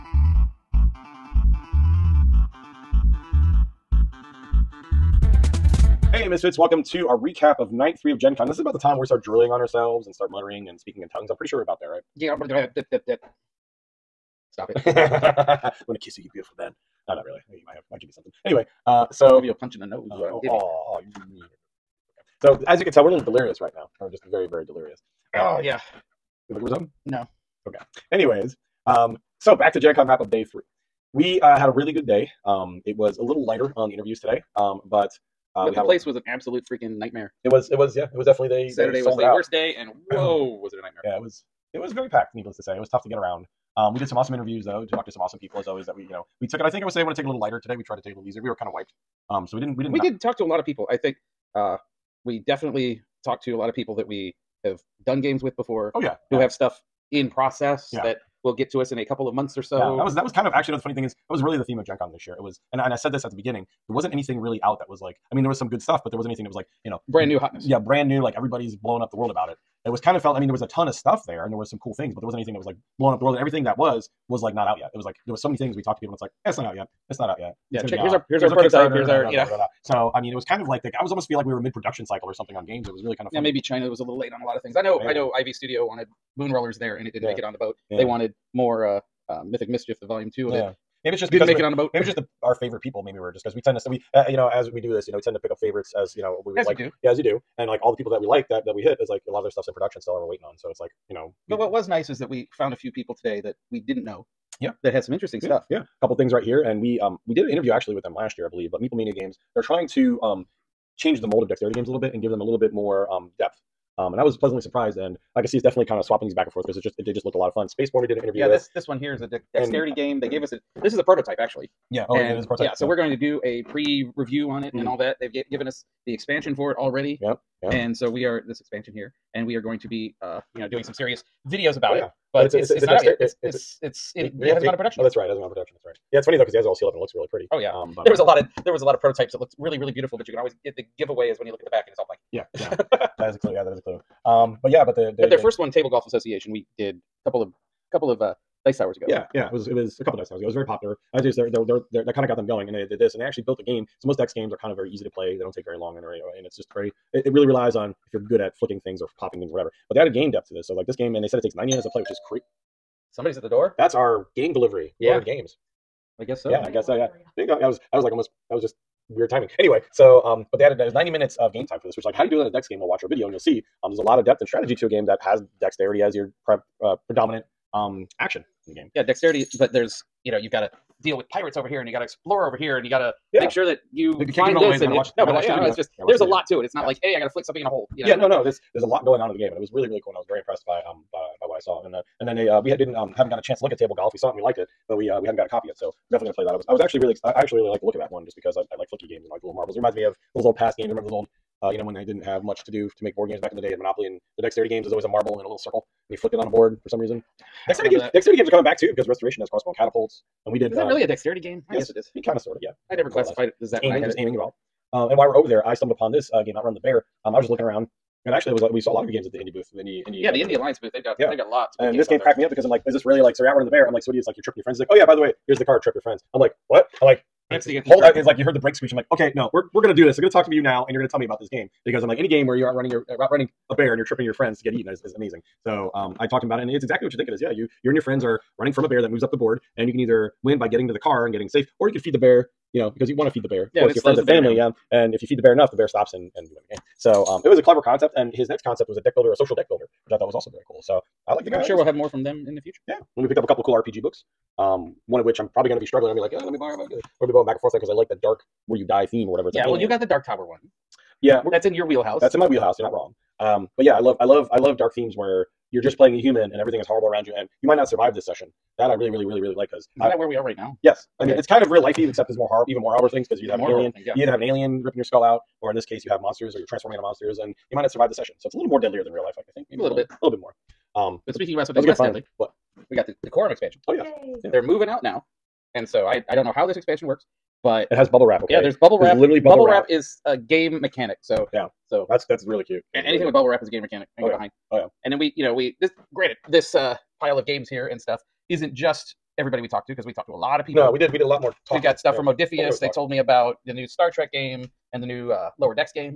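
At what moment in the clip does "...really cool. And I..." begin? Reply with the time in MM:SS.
03:09.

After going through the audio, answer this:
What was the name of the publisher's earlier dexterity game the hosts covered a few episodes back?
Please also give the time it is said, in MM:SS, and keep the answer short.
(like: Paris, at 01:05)
Table Golf Association, at 02:25.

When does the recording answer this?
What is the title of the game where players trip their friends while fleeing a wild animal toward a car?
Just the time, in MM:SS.
03:36.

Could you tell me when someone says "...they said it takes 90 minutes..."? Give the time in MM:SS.
02:41.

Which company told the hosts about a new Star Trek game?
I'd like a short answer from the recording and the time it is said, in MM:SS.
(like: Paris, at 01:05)
Modiphius, at 05:02.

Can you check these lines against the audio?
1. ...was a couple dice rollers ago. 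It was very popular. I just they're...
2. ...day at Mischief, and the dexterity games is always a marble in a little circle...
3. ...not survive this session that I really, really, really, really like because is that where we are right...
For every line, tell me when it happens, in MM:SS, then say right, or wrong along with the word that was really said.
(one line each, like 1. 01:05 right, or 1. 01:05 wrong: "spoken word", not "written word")
1. 02:29 wrong: "towers", not "rollers"
2. 03:23 wrong: "Monopoly", not "Mischief"
3. 04:27 right.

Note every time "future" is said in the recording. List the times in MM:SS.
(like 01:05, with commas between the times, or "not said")
04:12.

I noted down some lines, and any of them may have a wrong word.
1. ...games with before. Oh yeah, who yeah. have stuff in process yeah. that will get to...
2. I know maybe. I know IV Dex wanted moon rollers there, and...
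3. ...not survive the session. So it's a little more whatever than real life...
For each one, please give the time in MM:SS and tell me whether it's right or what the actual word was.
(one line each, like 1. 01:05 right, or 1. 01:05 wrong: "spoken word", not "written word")
1. 00:55 right
2. 01:24 wrong: "Studio", not "Dex"
3. 04:37 wrong: "deadlier", not "whatever".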